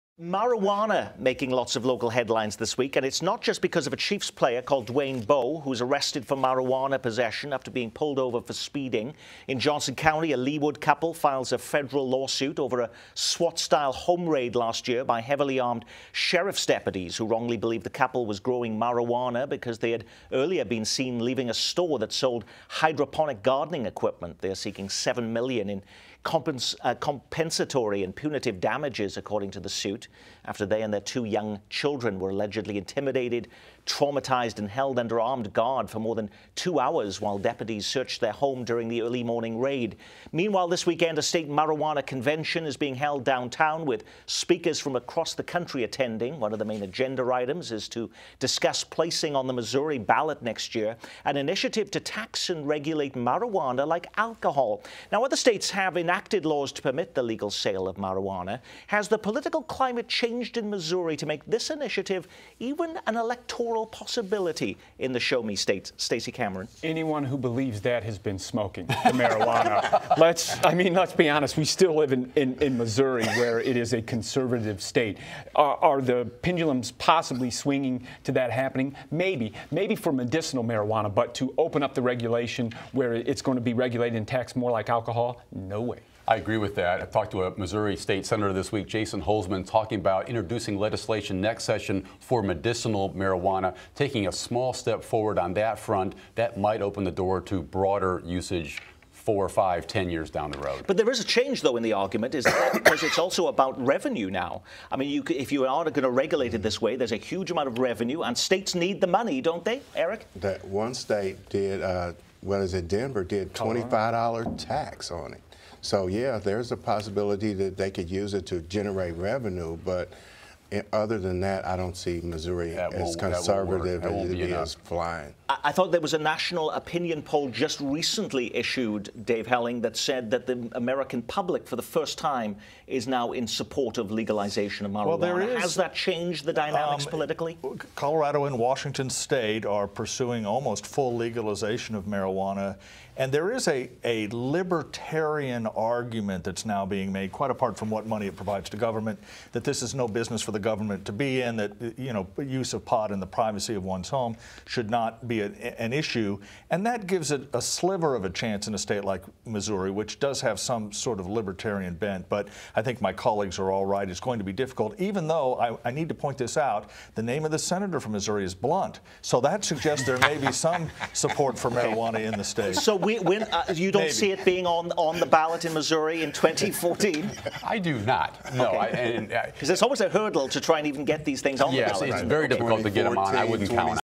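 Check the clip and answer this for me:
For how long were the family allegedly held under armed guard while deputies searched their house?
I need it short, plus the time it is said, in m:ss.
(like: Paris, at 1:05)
more than two hours, at 0:35.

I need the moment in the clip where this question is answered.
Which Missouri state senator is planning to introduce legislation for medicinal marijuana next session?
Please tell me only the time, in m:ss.
1:28.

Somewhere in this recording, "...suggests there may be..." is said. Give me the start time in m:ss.
2:49.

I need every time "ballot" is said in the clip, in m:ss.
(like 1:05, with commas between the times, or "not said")
0:49, 2:55, 3:01.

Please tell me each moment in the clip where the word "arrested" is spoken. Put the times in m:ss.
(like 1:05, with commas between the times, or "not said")
0:05.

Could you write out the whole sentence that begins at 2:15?
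Well, Has that changed the dynamics um, politically?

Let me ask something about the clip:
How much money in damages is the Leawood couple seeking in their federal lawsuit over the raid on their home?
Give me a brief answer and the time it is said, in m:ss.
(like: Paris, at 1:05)
$7 million, at 0:24.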